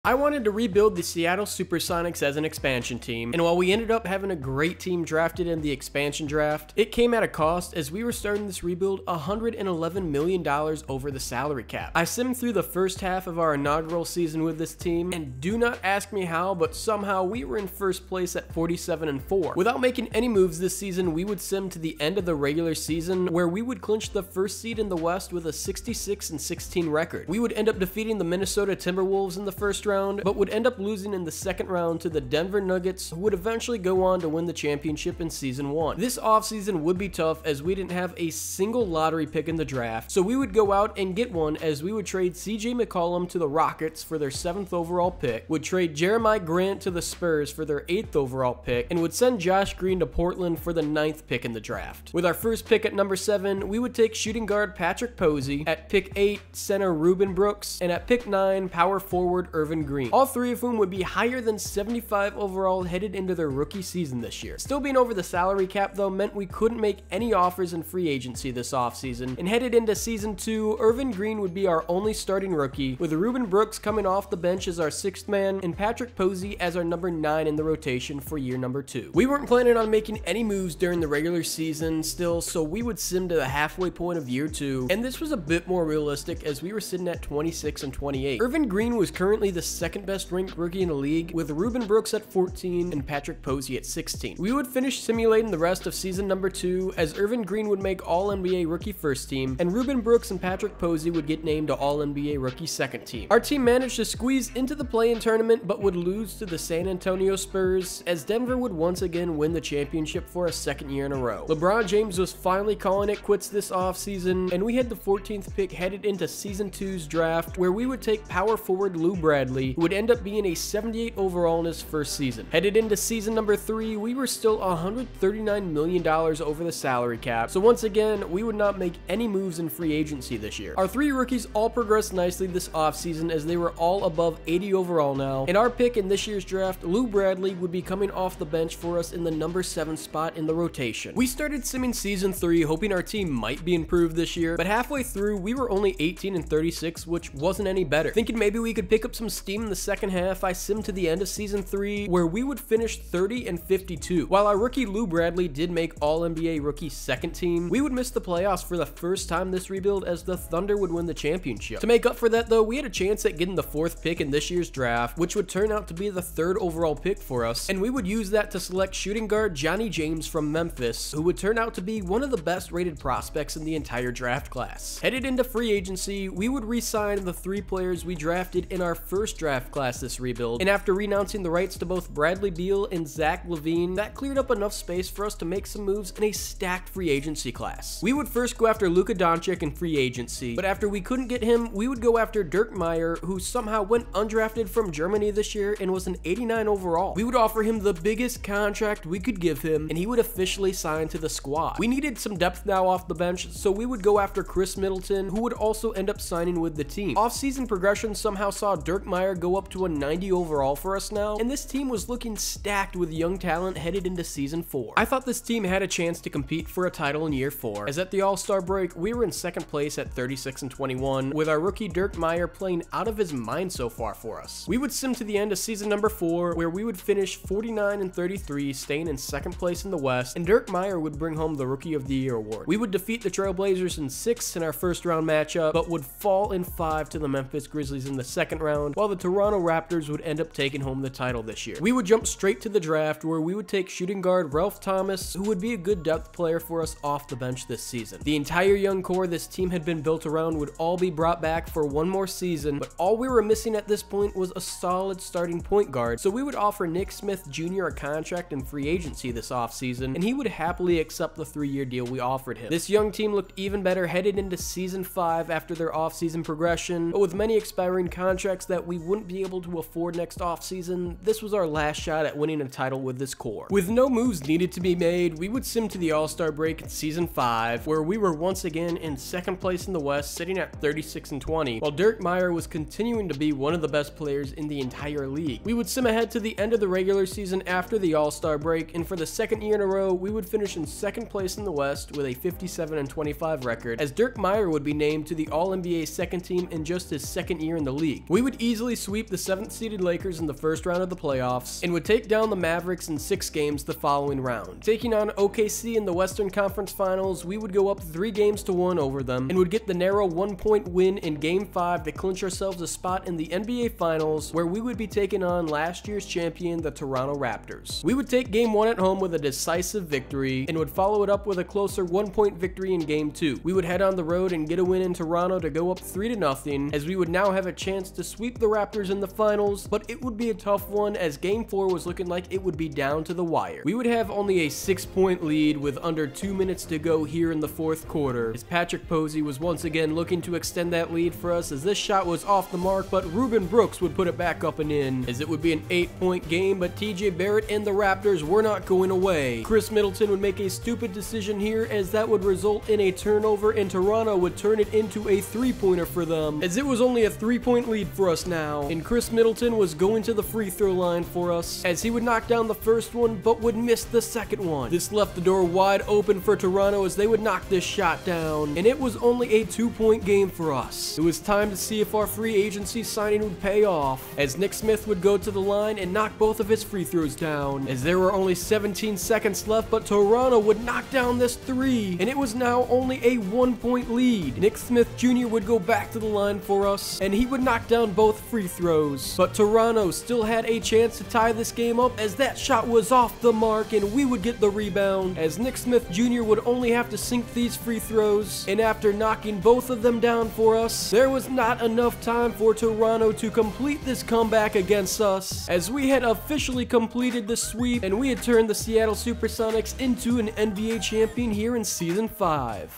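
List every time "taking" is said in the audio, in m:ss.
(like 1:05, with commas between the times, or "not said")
4:00, 5:04, 5:15.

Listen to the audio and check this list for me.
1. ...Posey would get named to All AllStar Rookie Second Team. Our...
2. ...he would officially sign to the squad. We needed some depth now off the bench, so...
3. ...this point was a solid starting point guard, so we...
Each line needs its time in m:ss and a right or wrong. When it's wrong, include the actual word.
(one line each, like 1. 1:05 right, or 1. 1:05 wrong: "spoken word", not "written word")
1. 1:40 wrong: "NBA", not "AllStar"
2. 3:19 right
3. 4:13 right.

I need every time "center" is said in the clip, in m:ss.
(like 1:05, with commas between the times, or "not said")
0:56.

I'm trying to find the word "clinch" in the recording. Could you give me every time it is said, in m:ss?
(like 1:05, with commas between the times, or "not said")
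0:23, 5:12.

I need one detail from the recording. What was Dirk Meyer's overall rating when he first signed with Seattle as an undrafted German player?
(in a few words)
89.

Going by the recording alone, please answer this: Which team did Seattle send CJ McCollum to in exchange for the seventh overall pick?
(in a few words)
Rockets.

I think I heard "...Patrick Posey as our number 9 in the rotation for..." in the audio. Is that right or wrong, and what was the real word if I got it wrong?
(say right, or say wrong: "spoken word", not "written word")
right.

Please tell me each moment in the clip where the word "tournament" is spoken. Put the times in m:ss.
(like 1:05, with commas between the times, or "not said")
1:45.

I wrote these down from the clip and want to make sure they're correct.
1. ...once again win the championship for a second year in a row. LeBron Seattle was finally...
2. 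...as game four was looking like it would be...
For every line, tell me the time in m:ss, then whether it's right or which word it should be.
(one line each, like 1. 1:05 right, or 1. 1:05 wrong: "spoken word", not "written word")
1. 1:48 wrong: "James", not "Seattle"
2. 5:31 right.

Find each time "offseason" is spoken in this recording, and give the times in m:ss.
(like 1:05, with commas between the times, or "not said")
0:36, 1:08, 1:53, 2:12, 3:27, 4:19, 4:25, 4:30.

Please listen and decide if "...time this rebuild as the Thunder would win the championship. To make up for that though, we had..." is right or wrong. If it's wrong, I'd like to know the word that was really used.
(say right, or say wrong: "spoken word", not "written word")
right.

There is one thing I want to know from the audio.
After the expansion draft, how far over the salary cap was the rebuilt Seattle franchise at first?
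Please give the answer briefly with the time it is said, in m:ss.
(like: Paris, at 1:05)
$111 million, at 0:09.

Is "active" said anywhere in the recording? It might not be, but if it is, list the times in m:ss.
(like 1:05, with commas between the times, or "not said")
not said.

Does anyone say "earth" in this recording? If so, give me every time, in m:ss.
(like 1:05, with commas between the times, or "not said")
not said.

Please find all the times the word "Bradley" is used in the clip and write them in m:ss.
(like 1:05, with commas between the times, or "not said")
1:59, 2:17, 2:35, 3:02.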